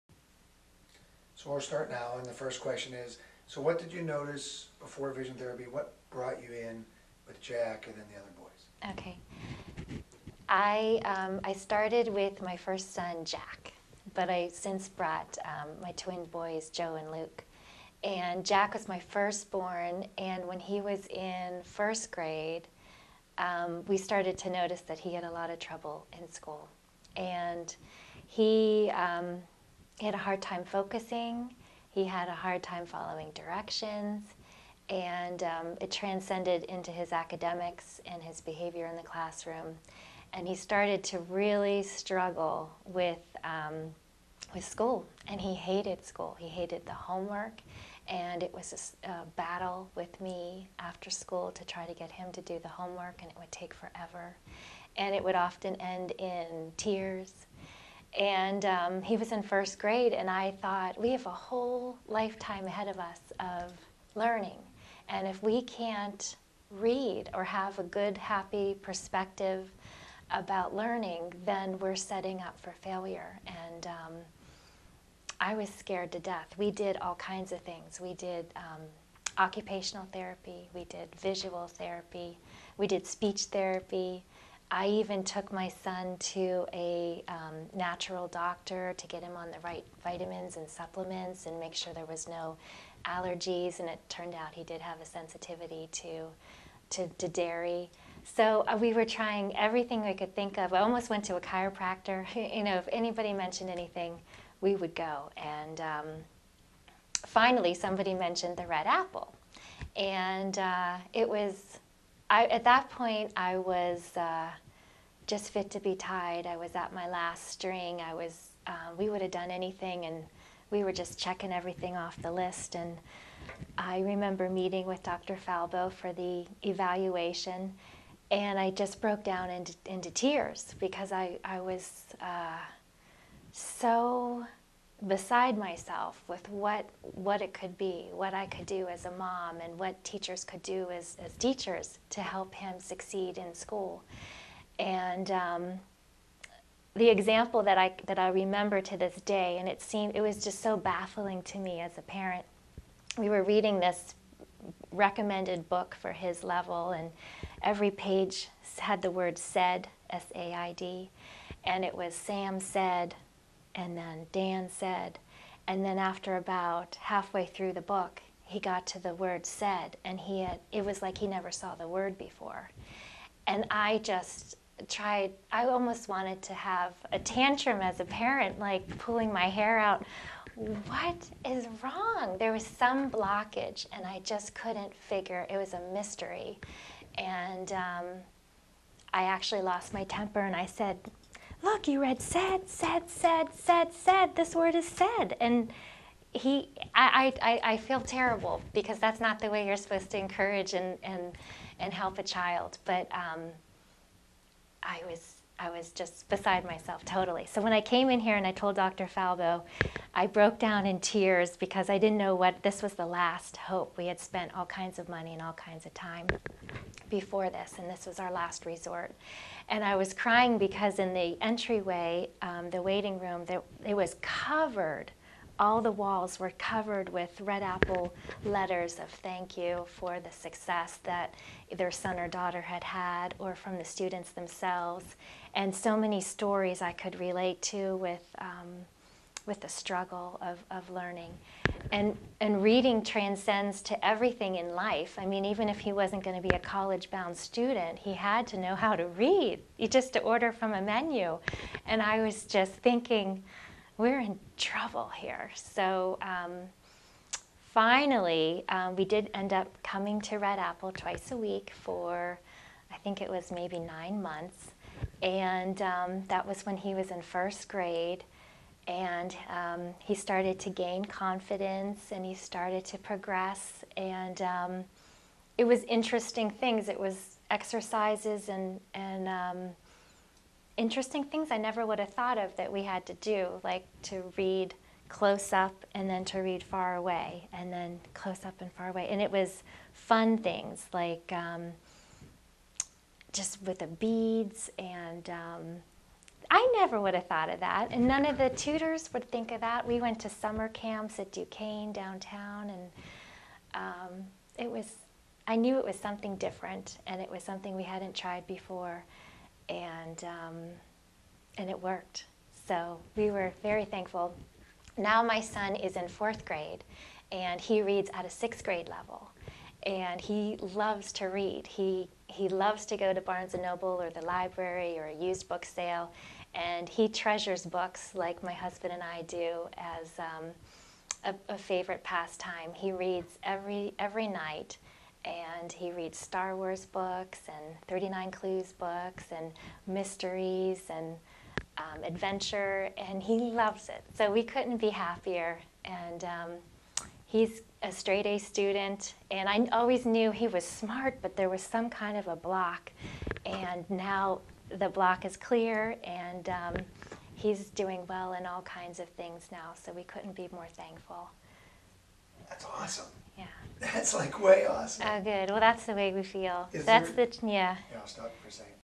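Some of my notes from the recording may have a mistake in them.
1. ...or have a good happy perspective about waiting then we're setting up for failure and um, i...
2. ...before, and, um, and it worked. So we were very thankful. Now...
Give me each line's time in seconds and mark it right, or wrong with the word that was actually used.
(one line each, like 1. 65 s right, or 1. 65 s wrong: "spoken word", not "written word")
1. 67 s wrong: "learning", not "waiting"
2. 308 s right.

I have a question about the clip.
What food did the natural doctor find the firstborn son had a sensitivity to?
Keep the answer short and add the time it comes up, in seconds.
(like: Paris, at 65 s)
Dairy, at 97 s.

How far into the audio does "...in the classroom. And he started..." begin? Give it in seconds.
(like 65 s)
38 s.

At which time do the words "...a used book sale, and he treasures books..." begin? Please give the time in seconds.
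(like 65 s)
325 s.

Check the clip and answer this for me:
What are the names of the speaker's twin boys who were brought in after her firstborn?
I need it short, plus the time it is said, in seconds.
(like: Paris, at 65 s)
Joe and Luke, at 16 s.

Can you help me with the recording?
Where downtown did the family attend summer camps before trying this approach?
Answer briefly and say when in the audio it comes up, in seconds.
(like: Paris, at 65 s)
Duquesne, at 301 s.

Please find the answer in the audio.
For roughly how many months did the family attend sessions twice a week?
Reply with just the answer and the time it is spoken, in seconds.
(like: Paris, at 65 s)
9, at 263 s.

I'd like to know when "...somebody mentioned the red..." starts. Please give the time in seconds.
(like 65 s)
107 s.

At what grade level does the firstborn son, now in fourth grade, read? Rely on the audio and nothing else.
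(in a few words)
6th grade.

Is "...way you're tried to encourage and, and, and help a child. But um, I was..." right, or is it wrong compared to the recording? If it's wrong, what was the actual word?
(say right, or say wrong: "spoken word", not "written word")
wrong: "supposed", not "tried".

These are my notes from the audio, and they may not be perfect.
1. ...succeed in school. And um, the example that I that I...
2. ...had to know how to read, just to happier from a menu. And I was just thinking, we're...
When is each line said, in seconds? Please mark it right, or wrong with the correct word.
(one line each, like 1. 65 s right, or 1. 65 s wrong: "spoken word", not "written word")
1. 142 s right
2. 248 s wrong: "order", not "happier".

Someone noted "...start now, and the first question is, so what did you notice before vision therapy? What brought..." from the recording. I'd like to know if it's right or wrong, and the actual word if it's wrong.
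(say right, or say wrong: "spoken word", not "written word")
right.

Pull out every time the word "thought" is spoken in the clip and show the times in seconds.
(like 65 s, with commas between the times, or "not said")
60 s, 282 s, 297 s.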